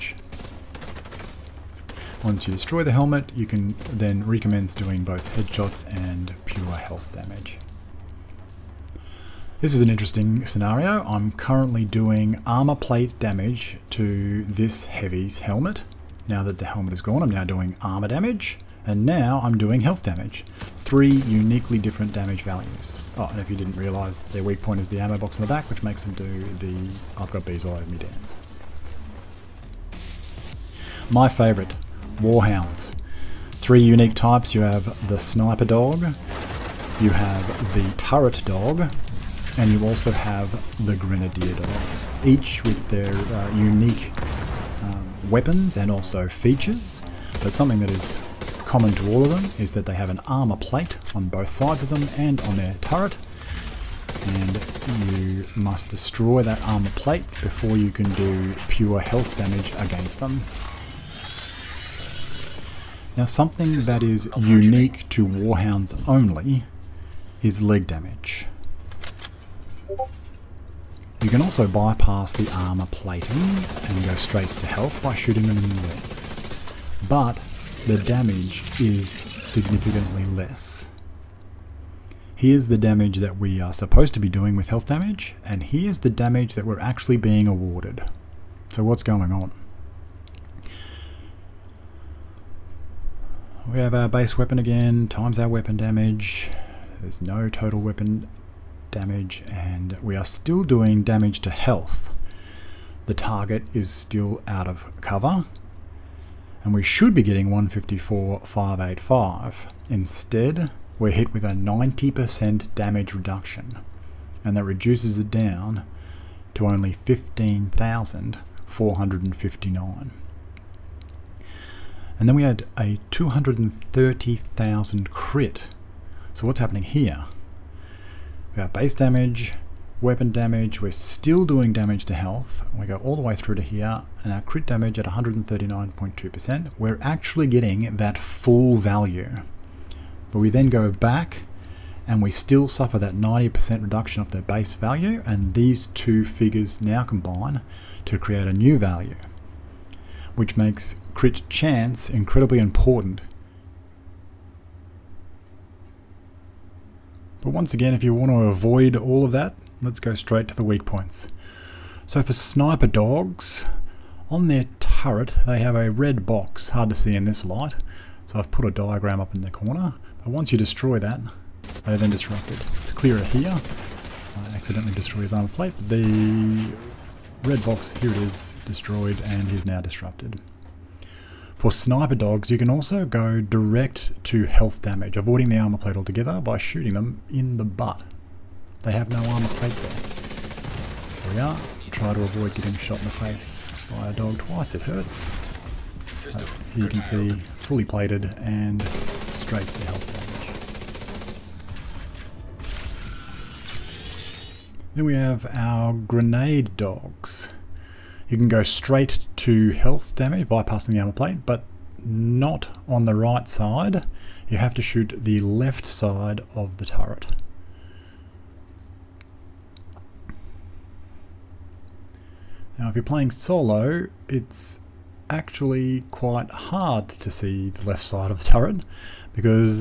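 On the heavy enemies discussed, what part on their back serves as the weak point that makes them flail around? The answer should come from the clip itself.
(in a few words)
ammo box.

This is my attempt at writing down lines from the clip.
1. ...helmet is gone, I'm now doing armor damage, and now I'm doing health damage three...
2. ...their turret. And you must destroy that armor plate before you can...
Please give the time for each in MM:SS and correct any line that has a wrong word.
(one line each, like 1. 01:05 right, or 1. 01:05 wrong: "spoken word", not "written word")
1. 00:16 right
2. 00:52 right.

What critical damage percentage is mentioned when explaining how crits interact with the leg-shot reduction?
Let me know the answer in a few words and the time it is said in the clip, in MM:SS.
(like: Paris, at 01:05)
139.2%, at 02:15.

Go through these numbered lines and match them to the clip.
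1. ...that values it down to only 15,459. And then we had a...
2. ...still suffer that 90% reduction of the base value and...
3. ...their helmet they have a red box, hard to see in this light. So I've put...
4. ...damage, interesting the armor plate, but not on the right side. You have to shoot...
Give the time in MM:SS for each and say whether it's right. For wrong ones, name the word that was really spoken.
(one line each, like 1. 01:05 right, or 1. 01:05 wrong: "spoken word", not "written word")
1. 01:54 wrong: "reduces", not "values"
2. 02:22 right
3. 02:44 wrong: "turret", not "helmet"
4. 03:30 wrong: "bypassing", not "interesting".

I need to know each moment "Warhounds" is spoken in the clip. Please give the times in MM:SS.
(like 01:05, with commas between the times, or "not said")
00:32, 01:05.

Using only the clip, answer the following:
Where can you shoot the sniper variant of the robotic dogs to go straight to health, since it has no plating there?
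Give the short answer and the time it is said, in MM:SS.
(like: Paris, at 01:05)
the butt, at 03:07.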